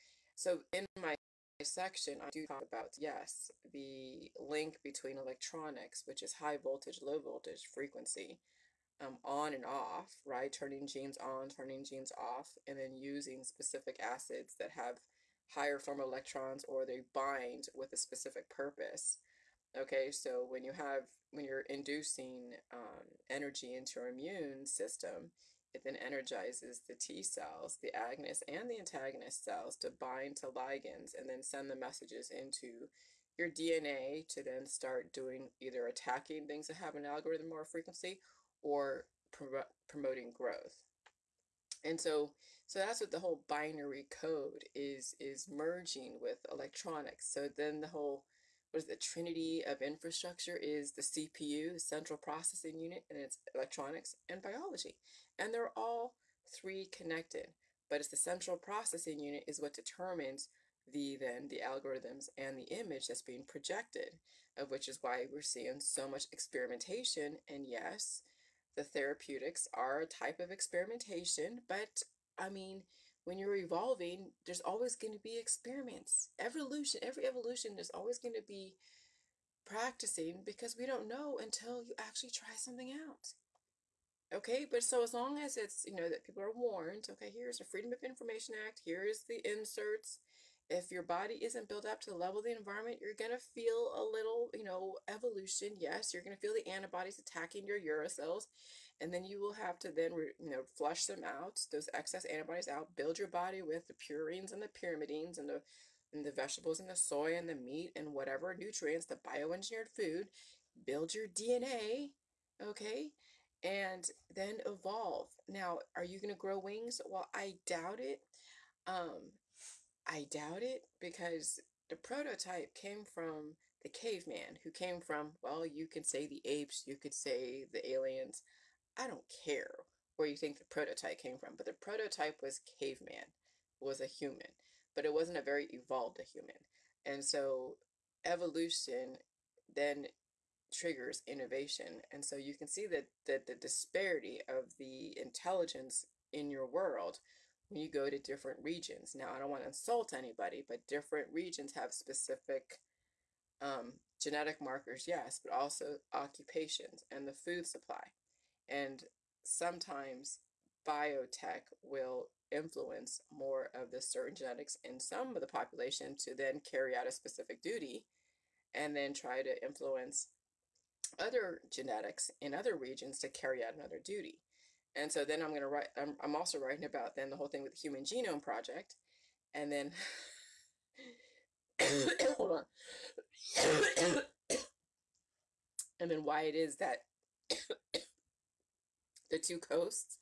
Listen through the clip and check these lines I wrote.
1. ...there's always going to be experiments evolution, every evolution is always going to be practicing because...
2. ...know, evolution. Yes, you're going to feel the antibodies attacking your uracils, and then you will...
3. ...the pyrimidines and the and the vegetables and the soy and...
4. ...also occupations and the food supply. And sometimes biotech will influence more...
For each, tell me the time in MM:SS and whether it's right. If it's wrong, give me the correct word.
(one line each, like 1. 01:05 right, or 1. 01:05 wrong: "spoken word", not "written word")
1. 01:14 right
2. 01:34 right
3. 01:44 right
4. 02:35 right.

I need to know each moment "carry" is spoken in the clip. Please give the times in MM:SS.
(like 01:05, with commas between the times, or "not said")
02:46, 02:53.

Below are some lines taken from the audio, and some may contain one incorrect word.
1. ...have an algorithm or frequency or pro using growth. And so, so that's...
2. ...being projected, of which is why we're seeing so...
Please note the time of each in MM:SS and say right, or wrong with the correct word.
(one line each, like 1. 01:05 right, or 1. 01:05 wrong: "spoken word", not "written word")
1. 00:36 wrong: "promoting", not "using"
2. 01:03 right.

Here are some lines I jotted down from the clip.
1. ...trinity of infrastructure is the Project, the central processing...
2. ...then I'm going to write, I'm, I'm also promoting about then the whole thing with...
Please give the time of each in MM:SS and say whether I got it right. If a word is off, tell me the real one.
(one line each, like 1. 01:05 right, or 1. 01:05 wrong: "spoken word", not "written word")
1. 00:48 wrong: "CPU", not "Project"
2. 02:55 wrong: "writing", not "promoting".